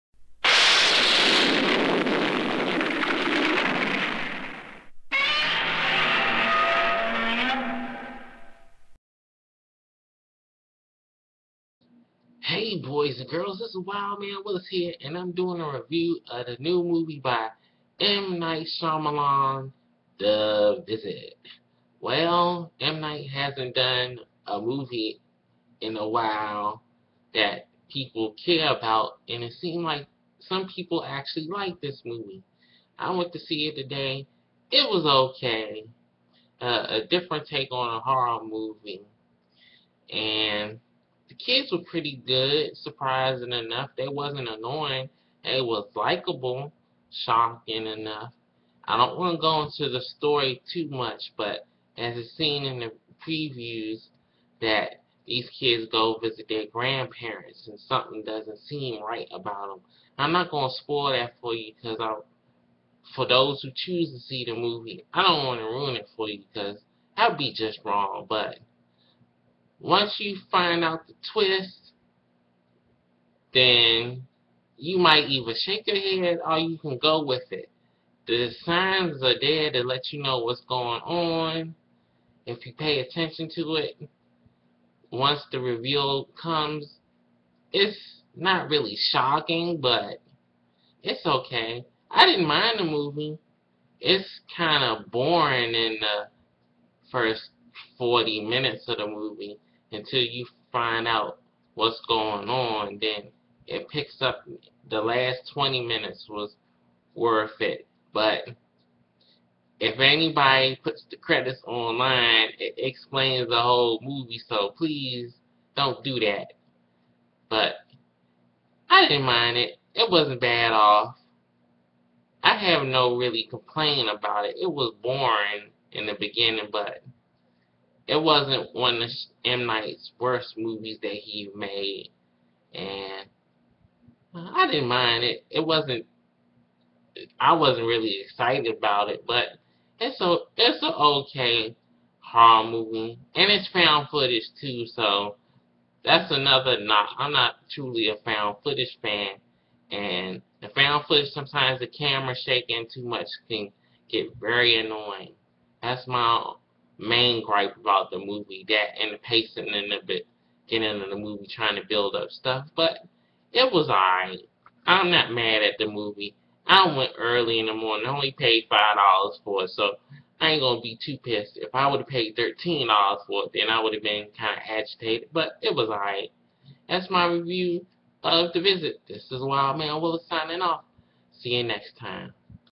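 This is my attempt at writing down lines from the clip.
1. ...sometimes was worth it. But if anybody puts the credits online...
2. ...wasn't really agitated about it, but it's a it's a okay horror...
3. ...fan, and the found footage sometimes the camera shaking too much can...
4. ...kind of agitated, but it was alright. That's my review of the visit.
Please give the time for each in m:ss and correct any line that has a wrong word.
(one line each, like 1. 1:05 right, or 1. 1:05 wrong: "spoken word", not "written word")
1. 1:45 wrong: "minutes", not "sometimes"
2. 2:17 wrong: "excited", not "agitated"
3. 2:29 right
4. 2:54 right.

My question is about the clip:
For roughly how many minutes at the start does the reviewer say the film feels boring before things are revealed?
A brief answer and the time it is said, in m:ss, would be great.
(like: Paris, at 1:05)
40, at 1:37.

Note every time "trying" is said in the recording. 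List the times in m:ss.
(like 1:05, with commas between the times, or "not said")
2:41.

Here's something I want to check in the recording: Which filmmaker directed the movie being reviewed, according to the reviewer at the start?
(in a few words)
M. Night Shyamalan.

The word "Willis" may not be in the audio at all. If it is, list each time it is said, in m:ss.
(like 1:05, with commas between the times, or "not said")
0:14, 3:00.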